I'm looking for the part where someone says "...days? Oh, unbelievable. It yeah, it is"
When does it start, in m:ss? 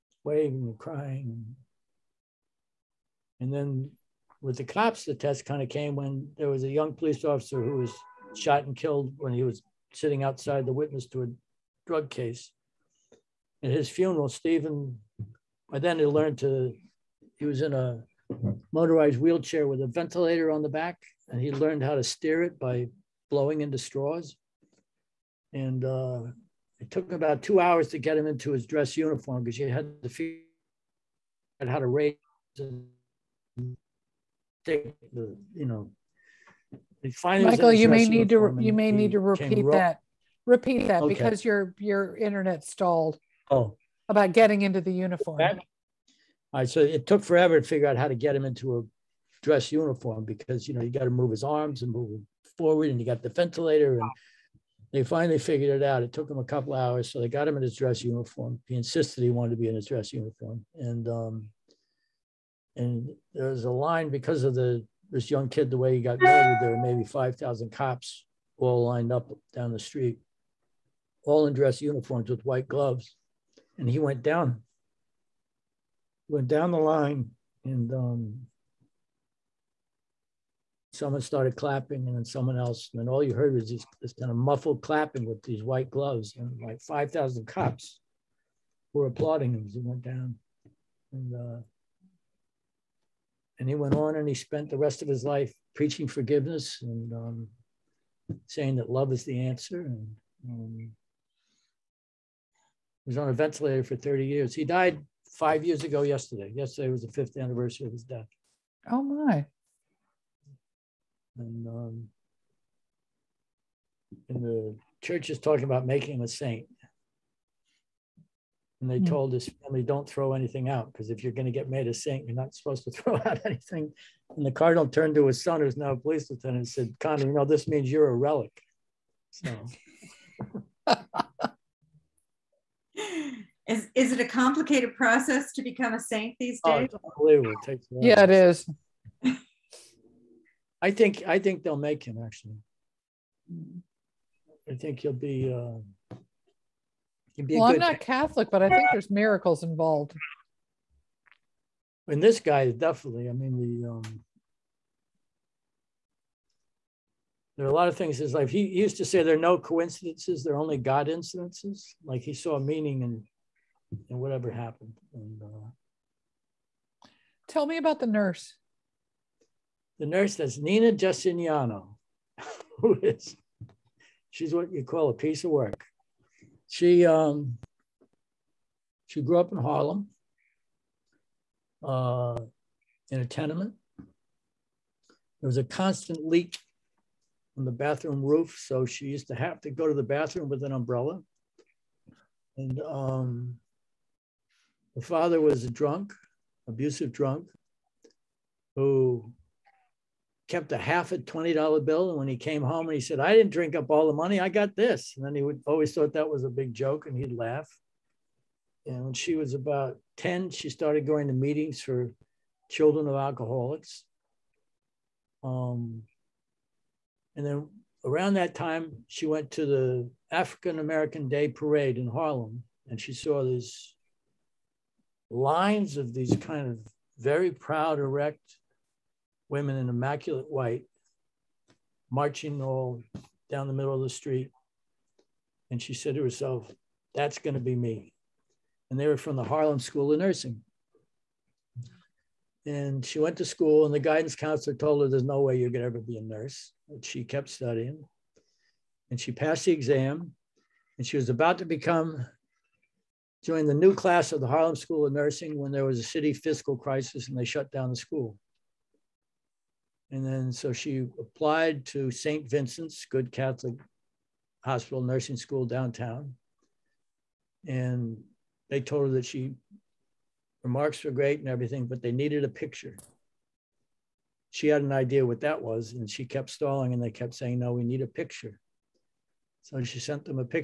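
2:16.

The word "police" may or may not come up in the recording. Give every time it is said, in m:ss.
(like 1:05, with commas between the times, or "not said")
0:06, 2:05.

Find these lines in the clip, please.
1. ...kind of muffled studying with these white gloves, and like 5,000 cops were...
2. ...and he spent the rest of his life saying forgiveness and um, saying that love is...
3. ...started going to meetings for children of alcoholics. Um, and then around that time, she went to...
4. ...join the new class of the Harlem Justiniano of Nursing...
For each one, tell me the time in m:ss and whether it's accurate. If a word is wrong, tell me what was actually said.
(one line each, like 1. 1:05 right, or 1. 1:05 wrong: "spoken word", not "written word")
1. 1:24 wrong: "clapping", not "studying"
2. 1:34 wrong: "preaching", not "saying"
3. 3:30 right
4. 4:13 wrong: "School", not "Justiniano".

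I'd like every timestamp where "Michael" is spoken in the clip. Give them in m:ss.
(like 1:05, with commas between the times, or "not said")
0:37.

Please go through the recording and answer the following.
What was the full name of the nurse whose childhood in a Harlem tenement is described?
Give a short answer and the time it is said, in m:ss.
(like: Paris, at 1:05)
Nina Justiniano, at 2:50.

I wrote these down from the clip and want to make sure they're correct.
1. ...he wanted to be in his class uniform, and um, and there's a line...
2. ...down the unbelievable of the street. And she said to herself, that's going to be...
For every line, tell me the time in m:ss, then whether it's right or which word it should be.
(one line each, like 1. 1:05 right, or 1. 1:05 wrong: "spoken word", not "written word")
1. 0:59 wrong: "dress", not "class"
2. 3:53 wrong: "middle", not "unbelievable".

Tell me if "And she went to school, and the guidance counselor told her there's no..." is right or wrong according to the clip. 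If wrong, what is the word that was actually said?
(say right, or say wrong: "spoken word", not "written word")
right.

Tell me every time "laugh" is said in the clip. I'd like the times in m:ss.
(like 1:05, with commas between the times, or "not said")
3:27.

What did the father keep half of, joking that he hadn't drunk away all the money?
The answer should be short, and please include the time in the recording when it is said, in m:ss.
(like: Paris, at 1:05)
$20 bill, at 3:21.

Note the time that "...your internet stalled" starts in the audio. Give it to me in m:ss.
0:41.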